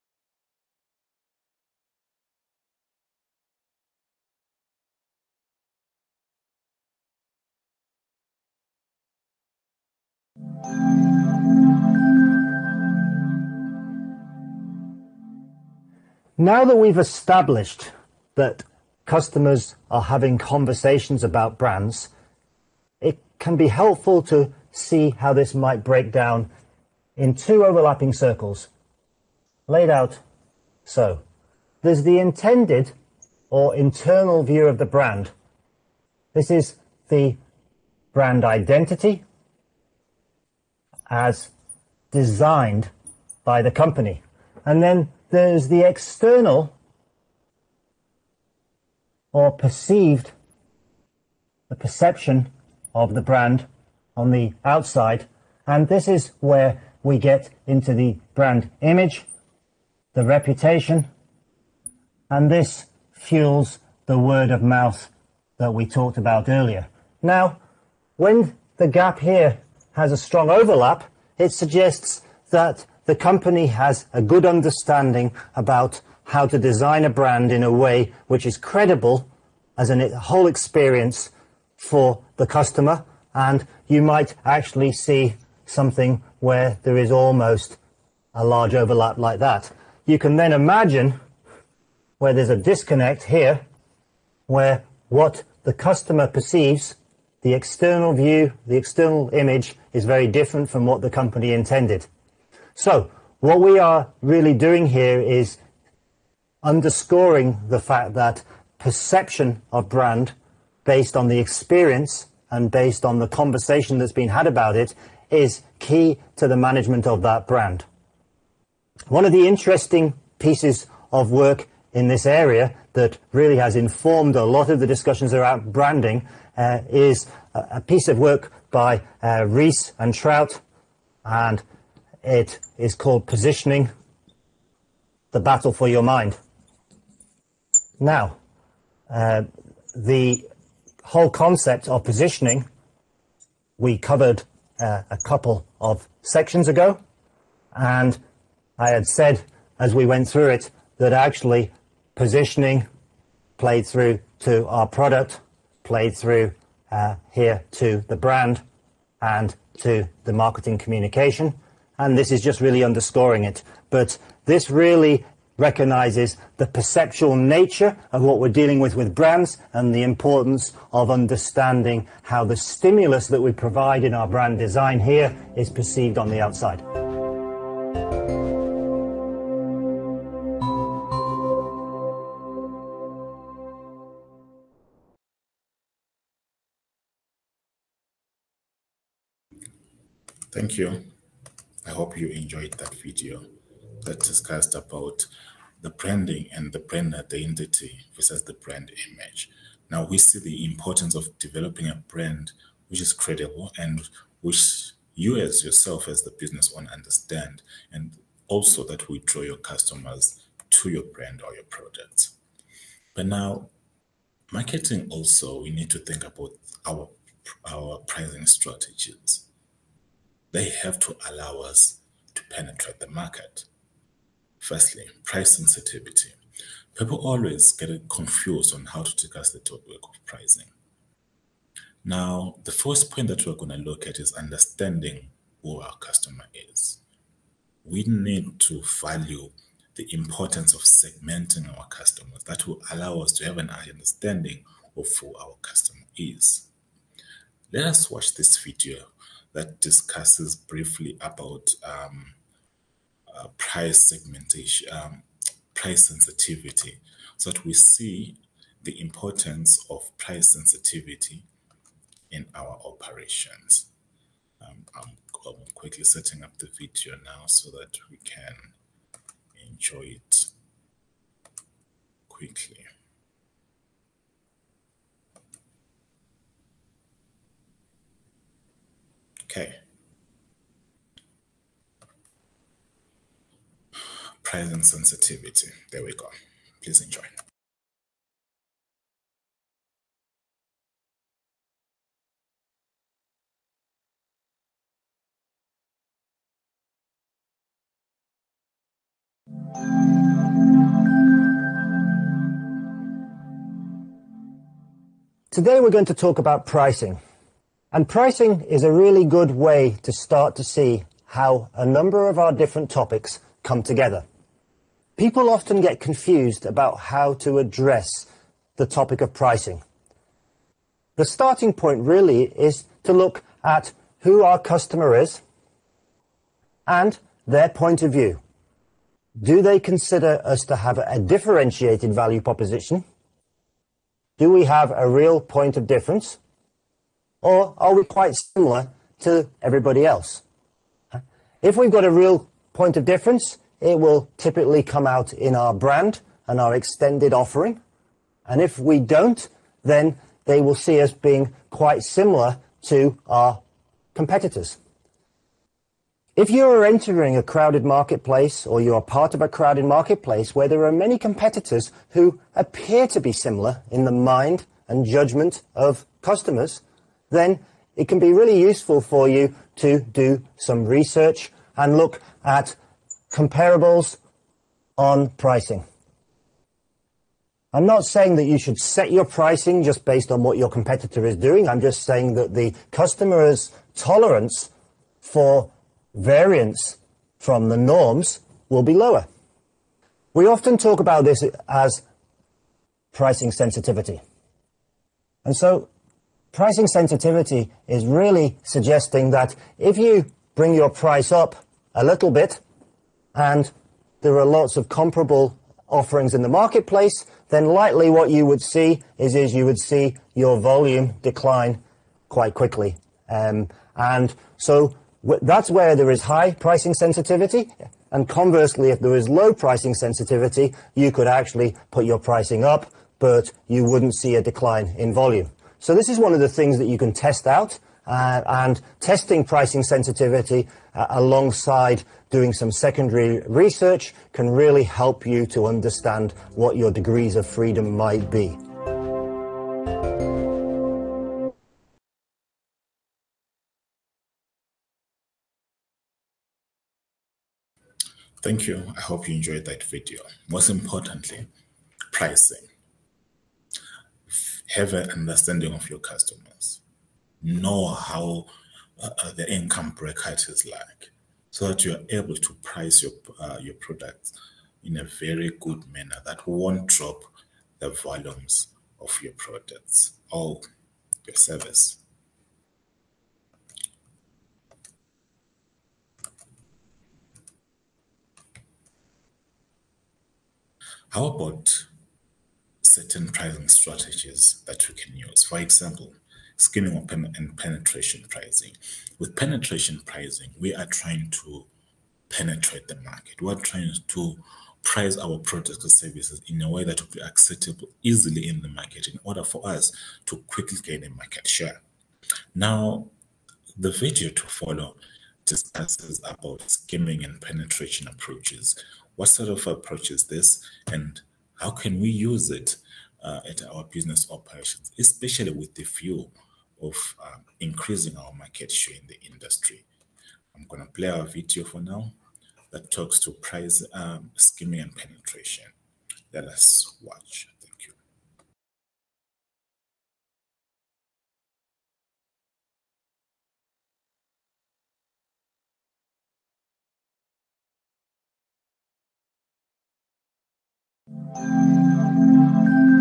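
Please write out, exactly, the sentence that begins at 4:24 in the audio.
Um, I'm, I'm quickly setting up the video now so that we can enjoy it quickly.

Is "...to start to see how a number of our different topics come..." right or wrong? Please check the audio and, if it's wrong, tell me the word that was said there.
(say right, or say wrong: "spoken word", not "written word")
right.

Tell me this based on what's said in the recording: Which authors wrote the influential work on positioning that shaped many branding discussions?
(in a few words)
Ries and Trout.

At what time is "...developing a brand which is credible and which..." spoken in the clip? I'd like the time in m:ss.
3:21.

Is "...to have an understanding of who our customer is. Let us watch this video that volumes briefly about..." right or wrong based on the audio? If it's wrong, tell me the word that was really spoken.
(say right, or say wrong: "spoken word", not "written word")
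wrong: "discusses", not "volumes".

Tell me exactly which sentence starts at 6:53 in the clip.
Um, and so that's where there is high pricing sensitivity.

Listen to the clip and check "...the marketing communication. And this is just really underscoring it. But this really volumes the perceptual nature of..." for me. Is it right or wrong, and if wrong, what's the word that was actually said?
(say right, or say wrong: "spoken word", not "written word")
wrong: "recognizes", not "volumes".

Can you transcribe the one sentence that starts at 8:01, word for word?
How about certain pricing strategies that we can use.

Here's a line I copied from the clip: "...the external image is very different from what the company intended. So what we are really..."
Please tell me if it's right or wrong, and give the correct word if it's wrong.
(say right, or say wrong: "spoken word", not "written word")
right.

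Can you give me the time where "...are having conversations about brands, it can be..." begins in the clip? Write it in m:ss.
0:19.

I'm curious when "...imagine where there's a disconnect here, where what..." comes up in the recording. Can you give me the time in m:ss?
1:30.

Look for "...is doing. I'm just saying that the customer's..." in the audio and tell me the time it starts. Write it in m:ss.
6:21.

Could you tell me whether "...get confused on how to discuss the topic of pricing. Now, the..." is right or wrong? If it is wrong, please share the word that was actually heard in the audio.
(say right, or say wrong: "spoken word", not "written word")
right.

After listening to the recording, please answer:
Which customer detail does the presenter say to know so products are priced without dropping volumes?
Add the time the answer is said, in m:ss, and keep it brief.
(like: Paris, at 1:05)
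income bracket, at 7:39.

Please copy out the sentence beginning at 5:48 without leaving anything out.
And if we don't, then they will see us being quite similar to our competitors.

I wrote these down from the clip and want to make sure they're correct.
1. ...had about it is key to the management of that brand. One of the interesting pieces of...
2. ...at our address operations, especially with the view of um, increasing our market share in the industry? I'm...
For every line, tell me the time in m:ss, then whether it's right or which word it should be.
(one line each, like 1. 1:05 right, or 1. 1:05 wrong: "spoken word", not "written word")
1. 1:54 right
2. 8:33 wrong: "business", not "address".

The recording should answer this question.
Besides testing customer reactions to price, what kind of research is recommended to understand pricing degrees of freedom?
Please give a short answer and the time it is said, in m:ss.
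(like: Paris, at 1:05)
secondary research, at 7:12.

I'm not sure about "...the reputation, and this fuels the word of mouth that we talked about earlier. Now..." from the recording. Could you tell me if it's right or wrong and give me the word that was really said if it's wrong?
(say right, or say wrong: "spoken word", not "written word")
right.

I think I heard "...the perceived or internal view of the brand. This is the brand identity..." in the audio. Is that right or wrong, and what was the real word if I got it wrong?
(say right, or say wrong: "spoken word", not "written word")
wrong: "intended", not "perceived".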